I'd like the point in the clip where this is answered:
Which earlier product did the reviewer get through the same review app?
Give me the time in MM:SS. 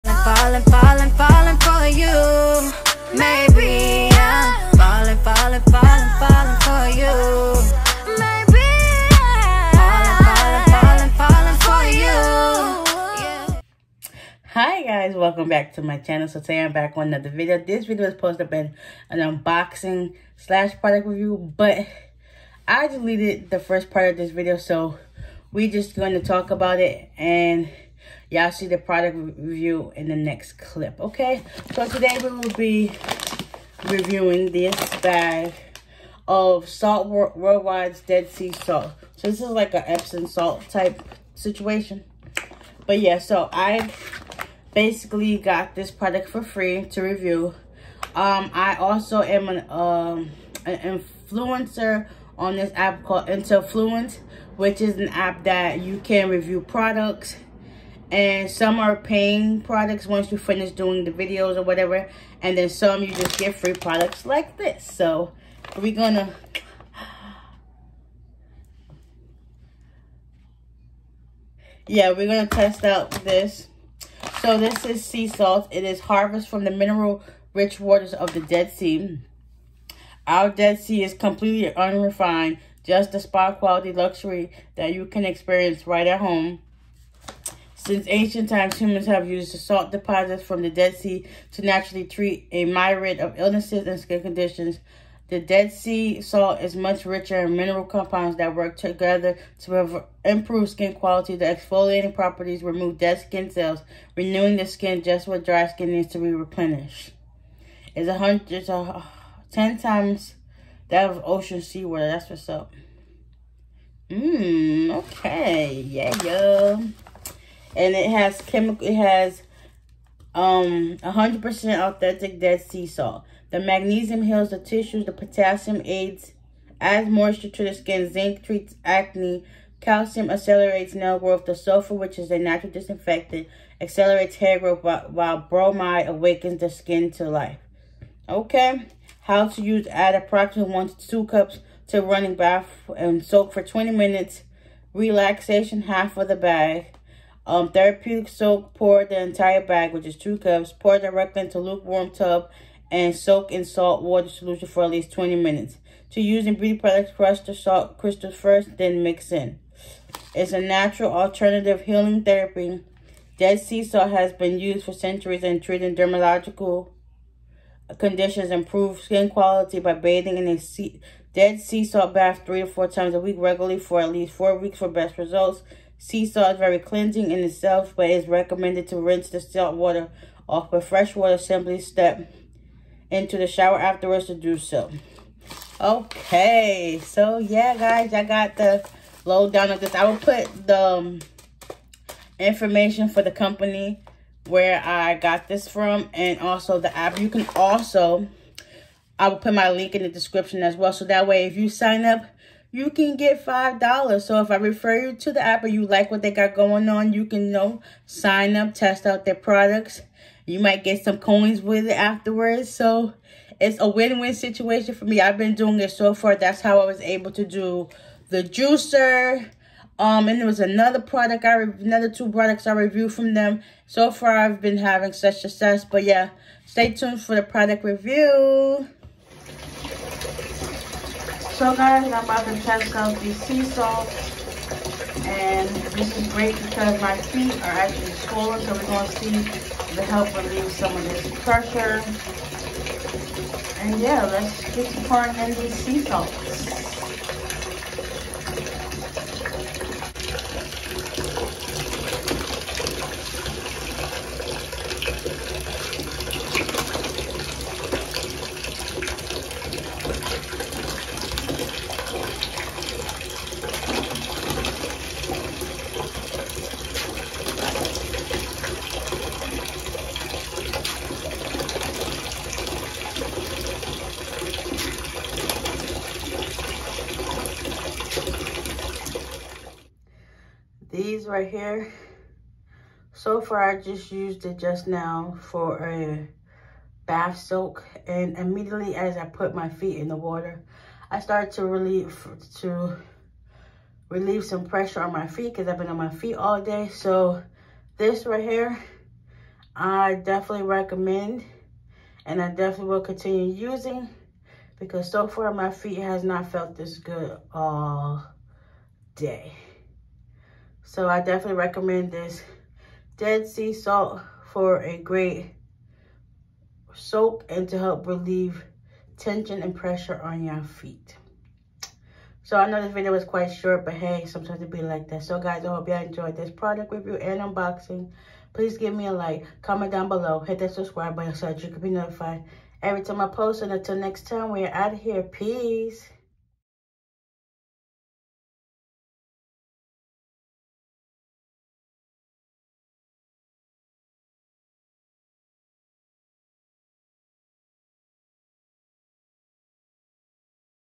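03:38.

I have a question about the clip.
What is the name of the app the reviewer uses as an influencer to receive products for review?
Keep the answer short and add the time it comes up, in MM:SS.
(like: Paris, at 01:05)
Intellifluence, at 00:53.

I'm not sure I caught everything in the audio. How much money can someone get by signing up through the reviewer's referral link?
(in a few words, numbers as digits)
$5.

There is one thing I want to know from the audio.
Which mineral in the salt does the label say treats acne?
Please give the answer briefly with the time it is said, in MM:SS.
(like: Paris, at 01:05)
zinc, at 02:08.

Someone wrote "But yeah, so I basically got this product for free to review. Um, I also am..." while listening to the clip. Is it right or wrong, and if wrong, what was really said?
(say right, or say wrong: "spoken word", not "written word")
right.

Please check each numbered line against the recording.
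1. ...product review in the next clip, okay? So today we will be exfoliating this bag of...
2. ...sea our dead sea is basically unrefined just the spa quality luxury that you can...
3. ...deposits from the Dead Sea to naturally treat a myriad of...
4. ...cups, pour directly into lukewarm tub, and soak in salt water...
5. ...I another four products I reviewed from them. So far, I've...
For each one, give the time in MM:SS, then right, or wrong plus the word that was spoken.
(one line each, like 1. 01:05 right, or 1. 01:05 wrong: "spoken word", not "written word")
1. 00:28 wrong: "reviewing", not "exfoliating"
2. 01:18 wrong: "completely", not "basically"
3. 01:29 right
4. 02:30 right
5. 03:41 wrong: "two", not "four".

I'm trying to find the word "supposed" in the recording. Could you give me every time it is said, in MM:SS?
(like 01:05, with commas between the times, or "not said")
00:18.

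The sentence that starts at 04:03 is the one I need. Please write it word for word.
And yeah, let's get pouring in the sea salt.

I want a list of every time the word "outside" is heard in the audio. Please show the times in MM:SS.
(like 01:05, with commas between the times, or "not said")
not said.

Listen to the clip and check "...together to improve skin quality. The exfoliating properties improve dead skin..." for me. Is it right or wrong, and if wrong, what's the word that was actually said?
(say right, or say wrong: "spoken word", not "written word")
wrong: "remove", not "improve".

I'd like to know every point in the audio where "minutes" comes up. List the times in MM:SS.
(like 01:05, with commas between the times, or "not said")
02:23, 02:35.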